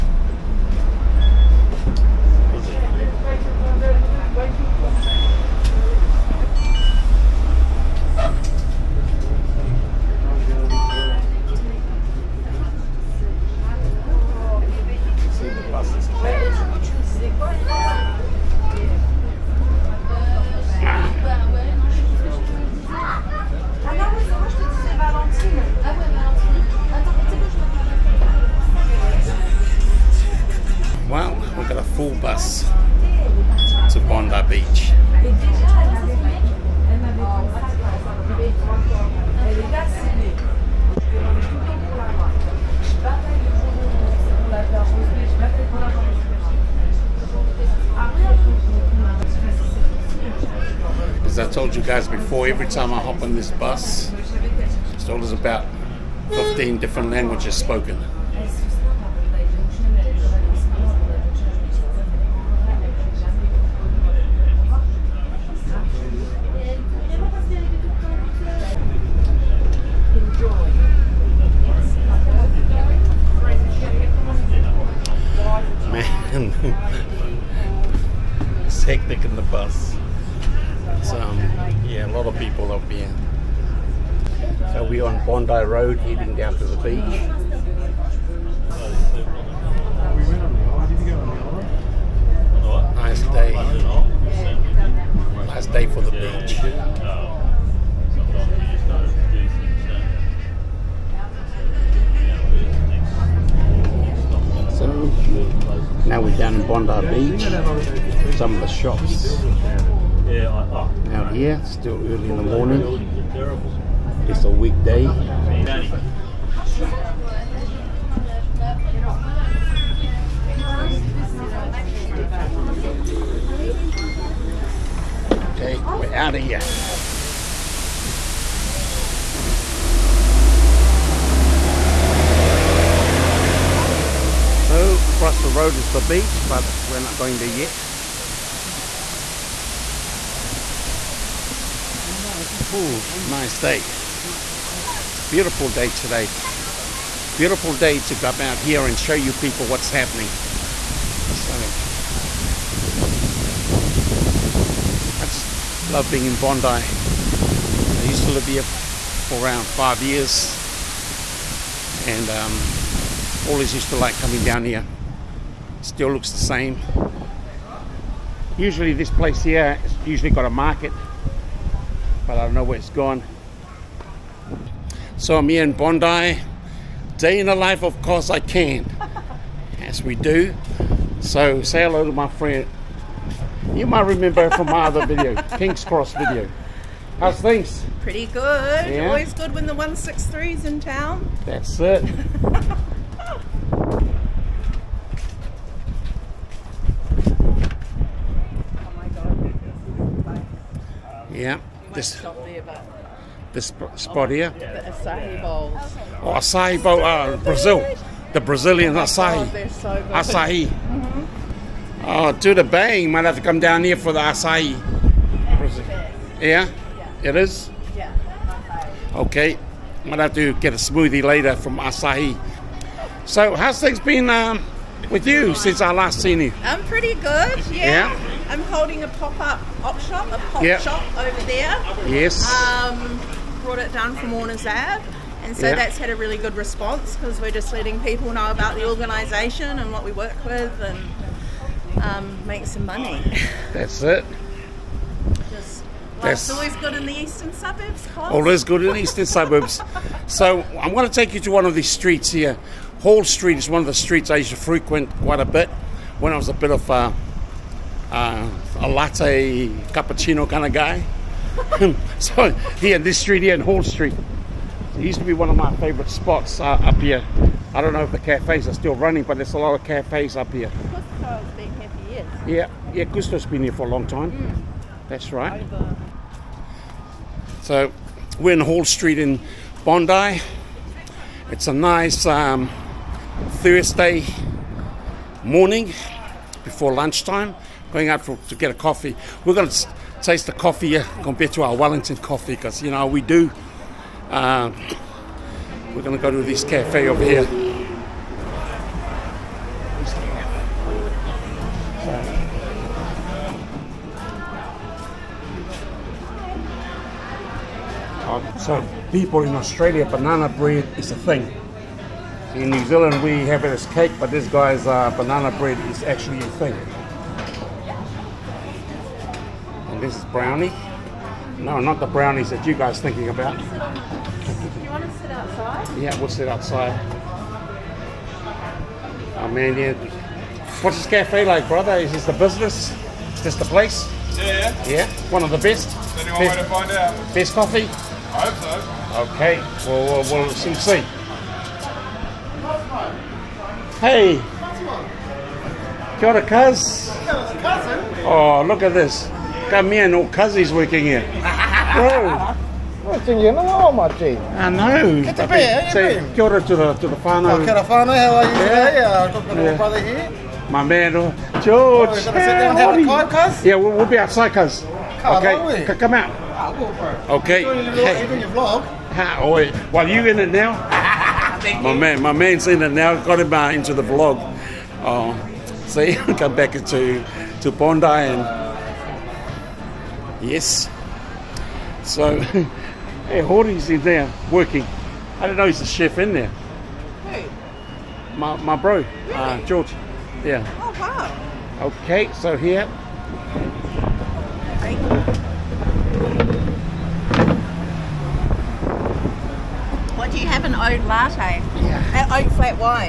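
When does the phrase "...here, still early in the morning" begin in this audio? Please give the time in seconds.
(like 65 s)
111 s.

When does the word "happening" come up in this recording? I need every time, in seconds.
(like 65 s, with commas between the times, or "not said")
149 s.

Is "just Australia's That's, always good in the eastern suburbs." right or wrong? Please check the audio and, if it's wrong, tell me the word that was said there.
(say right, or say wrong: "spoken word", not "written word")
wrong: "Life", not "Australia".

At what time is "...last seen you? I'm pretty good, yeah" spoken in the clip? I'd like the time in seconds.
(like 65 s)
225 s.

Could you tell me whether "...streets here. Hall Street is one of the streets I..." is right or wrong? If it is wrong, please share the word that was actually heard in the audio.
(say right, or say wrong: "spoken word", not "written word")
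right.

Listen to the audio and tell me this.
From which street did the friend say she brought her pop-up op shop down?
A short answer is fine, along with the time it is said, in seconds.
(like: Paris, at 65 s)
Warner's Ave, at 234 s.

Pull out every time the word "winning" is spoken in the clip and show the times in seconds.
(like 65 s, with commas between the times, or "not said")
not said.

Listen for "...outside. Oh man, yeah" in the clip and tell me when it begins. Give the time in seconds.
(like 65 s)
326 s.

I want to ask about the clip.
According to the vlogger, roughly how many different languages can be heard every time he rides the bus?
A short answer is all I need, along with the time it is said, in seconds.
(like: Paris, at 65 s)
15, at 56 s.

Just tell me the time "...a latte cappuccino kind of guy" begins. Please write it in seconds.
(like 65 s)
258 s.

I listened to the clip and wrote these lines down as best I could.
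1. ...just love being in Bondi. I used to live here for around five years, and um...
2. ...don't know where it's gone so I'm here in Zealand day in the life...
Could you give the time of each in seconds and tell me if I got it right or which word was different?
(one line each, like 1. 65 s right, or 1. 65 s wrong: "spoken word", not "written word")
1. 155 s right
2. 172 s wrong: "Bondi", not "Zealand".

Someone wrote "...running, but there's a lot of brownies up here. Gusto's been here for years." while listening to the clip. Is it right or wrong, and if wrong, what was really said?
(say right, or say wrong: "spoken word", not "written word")
wrong: "cafes", not "brownies".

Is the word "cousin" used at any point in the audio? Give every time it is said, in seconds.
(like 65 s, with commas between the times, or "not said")
350 s.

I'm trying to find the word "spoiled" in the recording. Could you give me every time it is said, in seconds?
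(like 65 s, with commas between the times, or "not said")
not said.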